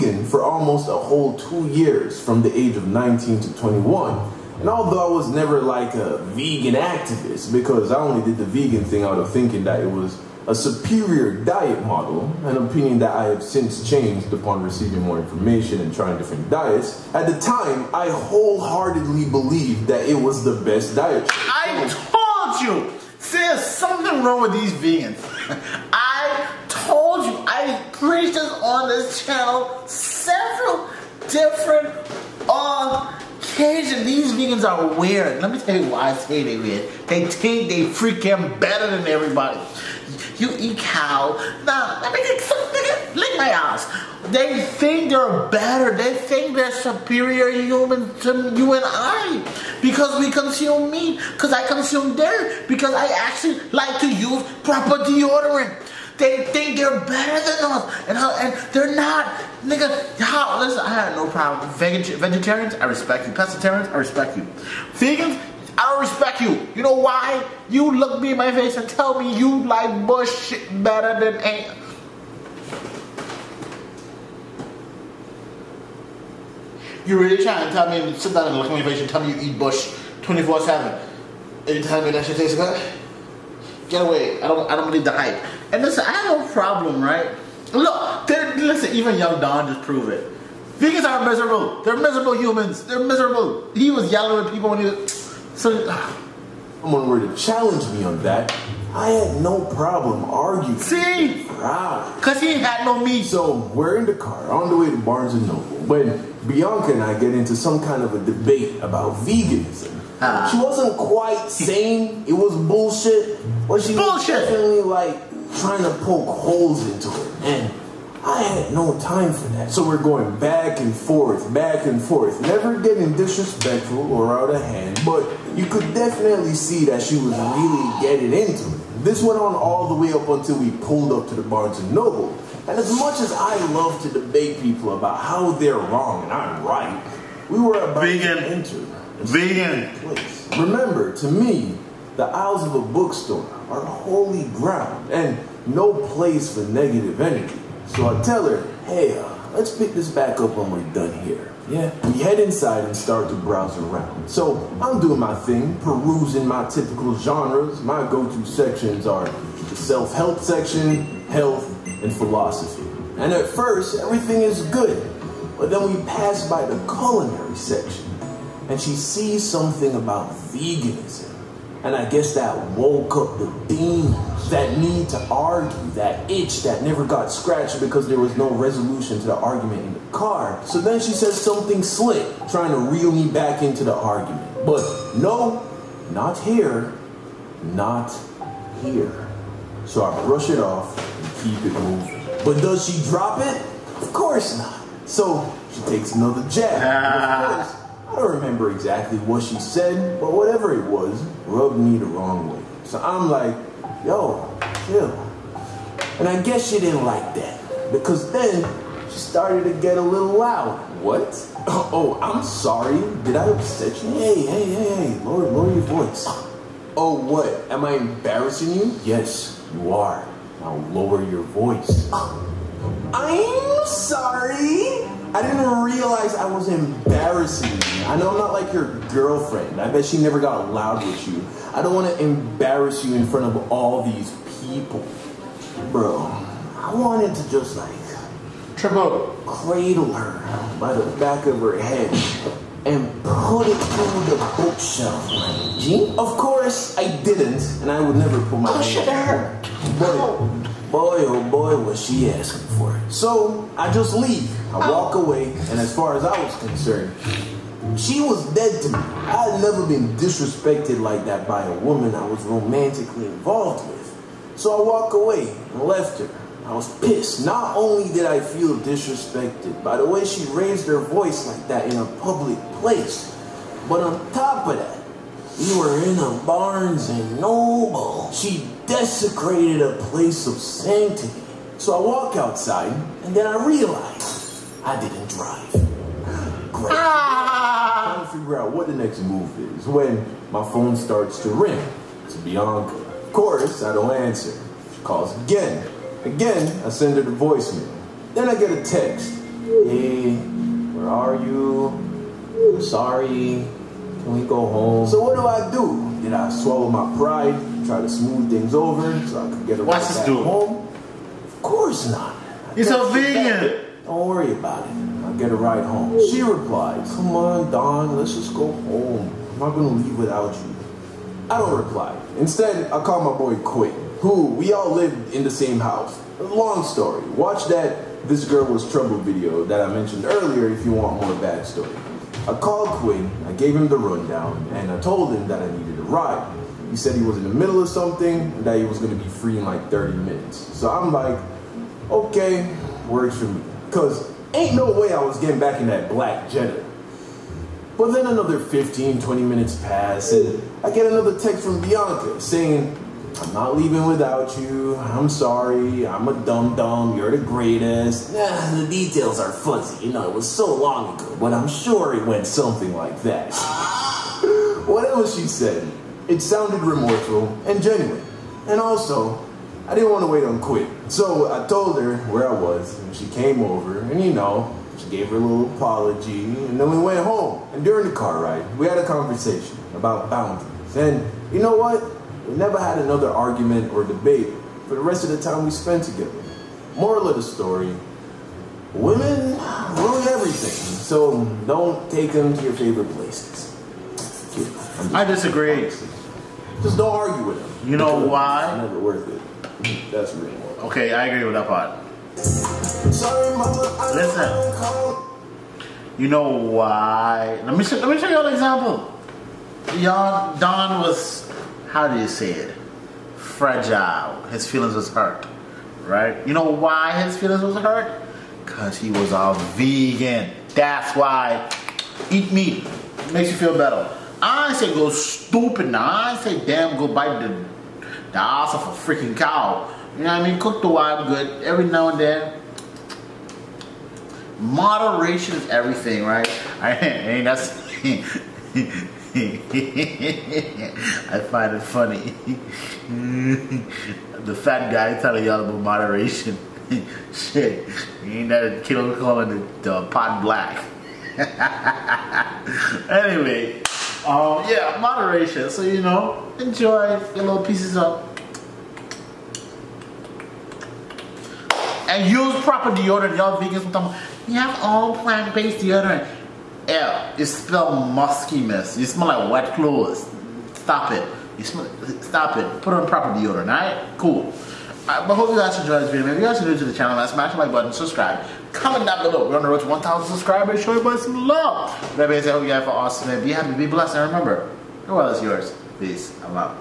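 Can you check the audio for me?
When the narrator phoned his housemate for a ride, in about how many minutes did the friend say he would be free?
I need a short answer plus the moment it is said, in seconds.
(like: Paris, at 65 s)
30 minutes, at 339 s.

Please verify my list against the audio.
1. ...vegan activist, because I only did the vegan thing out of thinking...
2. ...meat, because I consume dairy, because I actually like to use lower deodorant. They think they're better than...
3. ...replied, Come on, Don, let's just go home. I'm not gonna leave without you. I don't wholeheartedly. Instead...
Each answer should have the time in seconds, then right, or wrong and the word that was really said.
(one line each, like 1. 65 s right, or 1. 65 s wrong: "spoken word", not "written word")
1. 6 s right
2. 50 s wrong: "proper", not "lower"
3. 316 s wrong: "reply", not "wholeheartedly".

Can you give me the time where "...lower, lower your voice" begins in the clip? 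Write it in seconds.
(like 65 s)
215 s.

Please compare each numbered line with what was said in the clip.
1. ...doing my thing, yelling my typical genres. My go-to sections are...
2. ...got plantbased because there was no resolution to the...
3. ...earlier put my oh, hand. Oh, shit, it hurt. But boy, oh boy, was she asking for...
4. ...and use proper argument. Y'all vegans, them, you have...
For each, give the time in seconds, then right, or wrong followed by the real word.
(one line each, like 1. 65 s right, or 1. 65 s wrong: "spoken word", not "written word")
1. 155 s wrong: "perusing", not "yelling"
2. 177 s wrong: "scratched", not "plantbased"
3. 248 s wrong: "never", not "earlier"
4. 462 s wrong: "deodorant", not "argument".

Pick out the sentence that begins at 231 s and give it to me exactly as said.
I don't want to embarrass you in front of all these people.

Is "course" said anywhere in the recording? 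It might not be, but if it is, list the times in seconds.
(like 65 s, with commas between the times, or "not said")
194 s, 246 s, 293 s, 311 s.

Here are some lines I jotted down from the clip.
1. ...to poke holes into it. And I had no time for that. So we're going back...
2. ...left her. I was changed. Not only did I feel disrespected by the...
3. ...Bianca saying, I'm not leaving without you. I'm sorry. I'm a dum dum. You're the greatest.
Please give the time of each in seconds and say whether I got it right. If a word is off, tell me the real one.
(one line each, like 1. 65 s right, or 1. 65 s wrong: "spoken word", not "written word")
1. 115 s right
2. 265 s wrong: "pissed", not "changed"
3. 351 s right.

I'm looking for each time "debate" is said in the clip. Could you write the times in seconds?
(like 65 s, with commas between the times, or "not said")
108 s, 134 s, 384 s.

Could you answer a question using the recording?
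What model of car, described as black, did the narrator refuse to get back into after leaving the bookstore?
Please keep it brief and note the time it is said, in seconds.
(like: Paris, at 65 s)
Jetta, at 346 s.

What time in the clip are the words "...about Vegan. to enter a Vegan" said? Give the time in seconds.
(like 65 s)
137 s.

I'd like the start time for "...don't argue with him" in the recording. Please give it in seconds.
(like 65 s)
396 s.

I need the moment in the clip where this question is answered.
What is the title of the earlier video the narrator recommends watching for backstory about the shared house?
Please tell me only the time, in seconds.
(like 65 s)
328 s.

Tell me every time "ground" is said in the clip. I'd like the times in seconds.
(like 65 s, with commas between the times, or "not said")
144 s.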